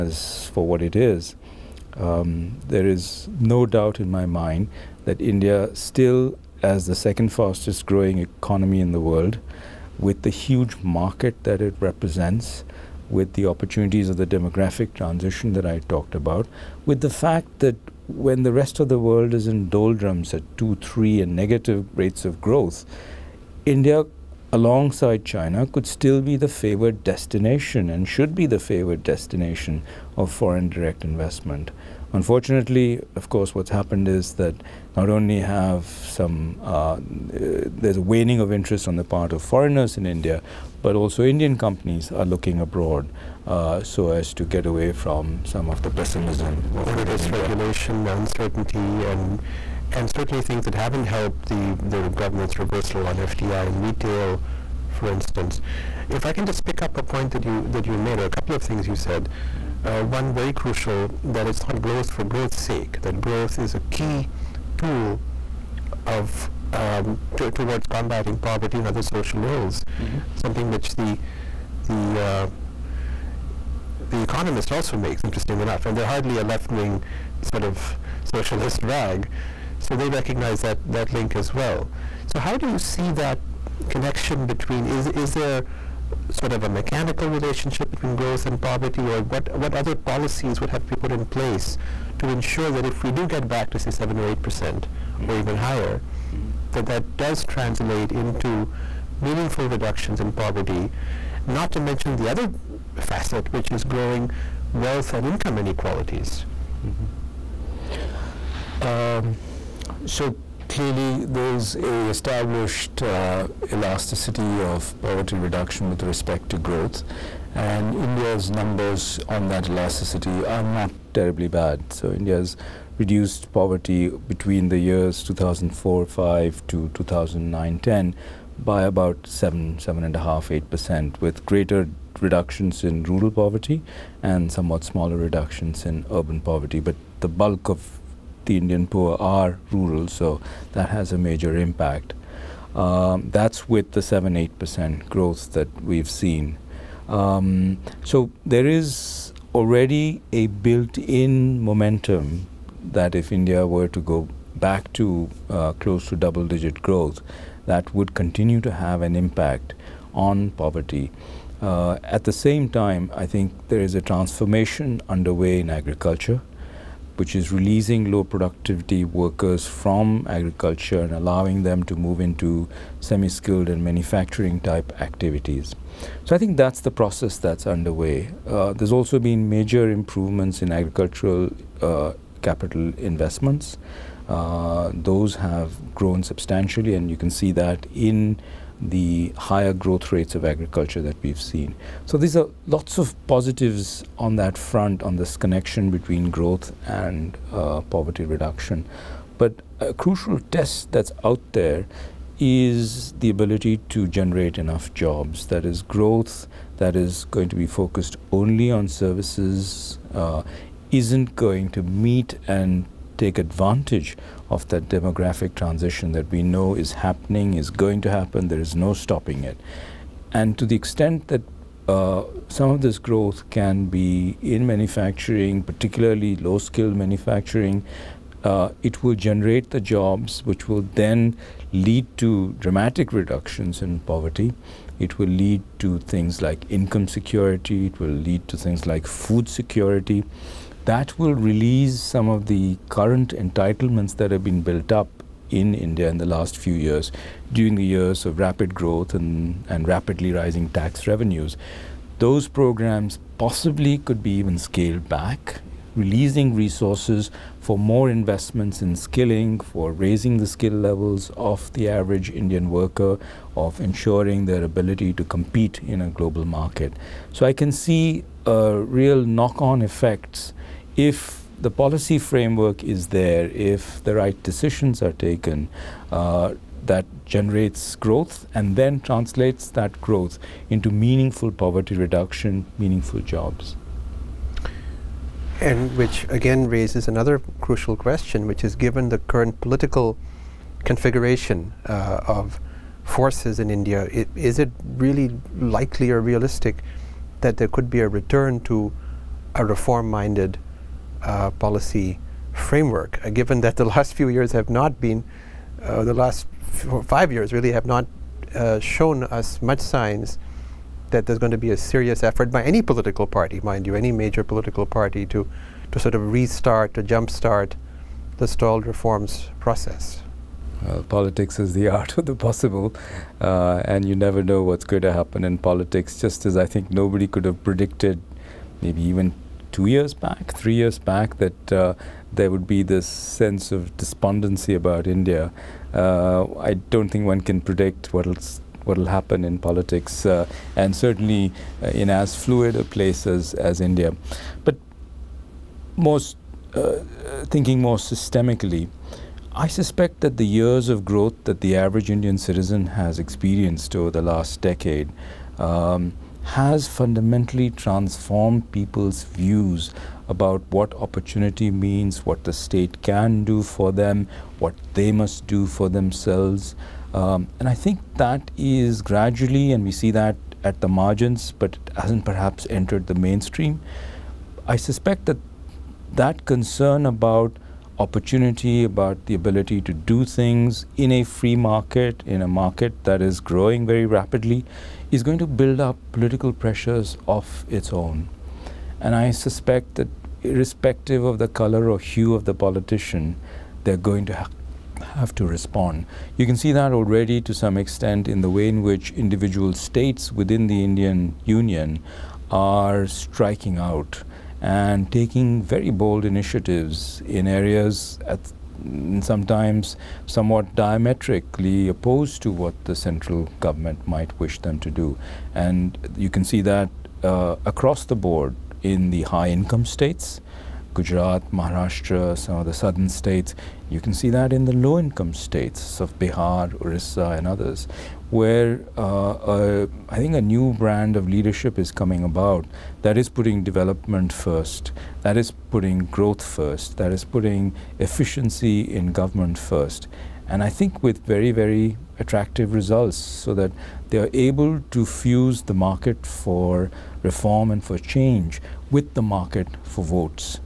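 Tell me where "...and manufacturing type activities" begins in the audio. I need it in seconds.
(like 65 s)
173 s.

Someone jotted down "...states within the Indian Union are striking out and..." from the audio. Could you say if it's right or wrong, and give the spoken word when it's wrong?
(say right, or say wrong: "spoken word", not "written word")
right.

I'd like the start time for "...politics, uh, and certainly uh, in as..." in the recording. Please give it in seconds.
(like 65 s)
339 s.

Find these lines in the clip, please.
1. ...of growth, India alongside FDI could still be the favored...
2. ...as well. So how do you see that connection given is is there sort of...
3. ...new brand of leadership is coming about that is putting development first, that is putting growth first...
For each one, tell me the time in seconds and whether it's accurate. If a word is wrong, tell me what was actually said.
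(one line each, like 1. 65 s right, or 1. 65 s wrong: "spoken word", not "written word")
1. 22 s wrong: "China", not "FDI"
2. 81 s wrong: "between", not "given"
3. 430 s right.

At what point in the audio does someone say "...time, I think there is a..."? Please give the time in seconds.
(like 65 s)
162 s.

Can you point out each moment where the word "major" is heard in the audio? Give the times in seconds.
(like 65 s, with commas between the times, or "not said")
141 s, 179 s, 314 s.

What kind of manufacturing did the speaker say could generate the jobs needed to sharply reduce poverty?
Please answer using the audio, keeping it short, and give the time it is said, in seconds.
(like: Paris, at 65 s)
Low skilled manufacturing, at 226 s.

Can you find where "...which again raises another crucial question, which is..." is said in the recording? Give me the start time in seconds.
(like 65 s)
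285 s.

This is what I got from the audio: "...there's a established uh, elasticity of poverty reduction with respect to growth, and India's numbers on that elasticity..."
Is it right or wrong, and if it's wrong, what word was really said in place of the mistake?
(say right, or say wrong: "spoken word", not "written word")
right.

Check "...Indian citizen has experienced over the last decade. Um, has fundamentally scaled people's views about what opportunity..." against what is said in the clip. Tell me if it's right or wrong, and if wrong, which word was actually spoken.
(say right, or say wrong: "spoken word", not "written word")
wrong: "transformed", not "scaled".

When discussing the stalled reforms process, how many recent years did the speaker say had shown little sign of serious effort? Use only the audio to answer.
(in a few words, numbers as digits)
5.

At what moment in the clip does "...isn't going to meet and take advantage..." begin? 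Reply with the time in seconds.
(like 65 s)
210 s.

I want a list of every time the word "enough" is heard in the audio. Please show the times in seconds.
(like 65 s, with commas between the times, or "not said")
75 s, 204 s.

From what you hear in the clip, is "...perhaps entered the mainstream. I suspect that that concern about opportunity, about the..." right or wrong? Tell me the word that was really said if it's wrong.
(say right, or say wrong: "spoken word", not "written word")
right.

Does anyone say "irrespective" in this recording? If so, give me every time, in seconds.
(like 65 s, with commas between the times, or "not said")
390 s.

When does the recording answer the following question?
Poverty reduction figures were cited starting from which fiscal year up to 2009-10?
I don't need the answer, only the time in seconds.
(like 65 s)
125 s.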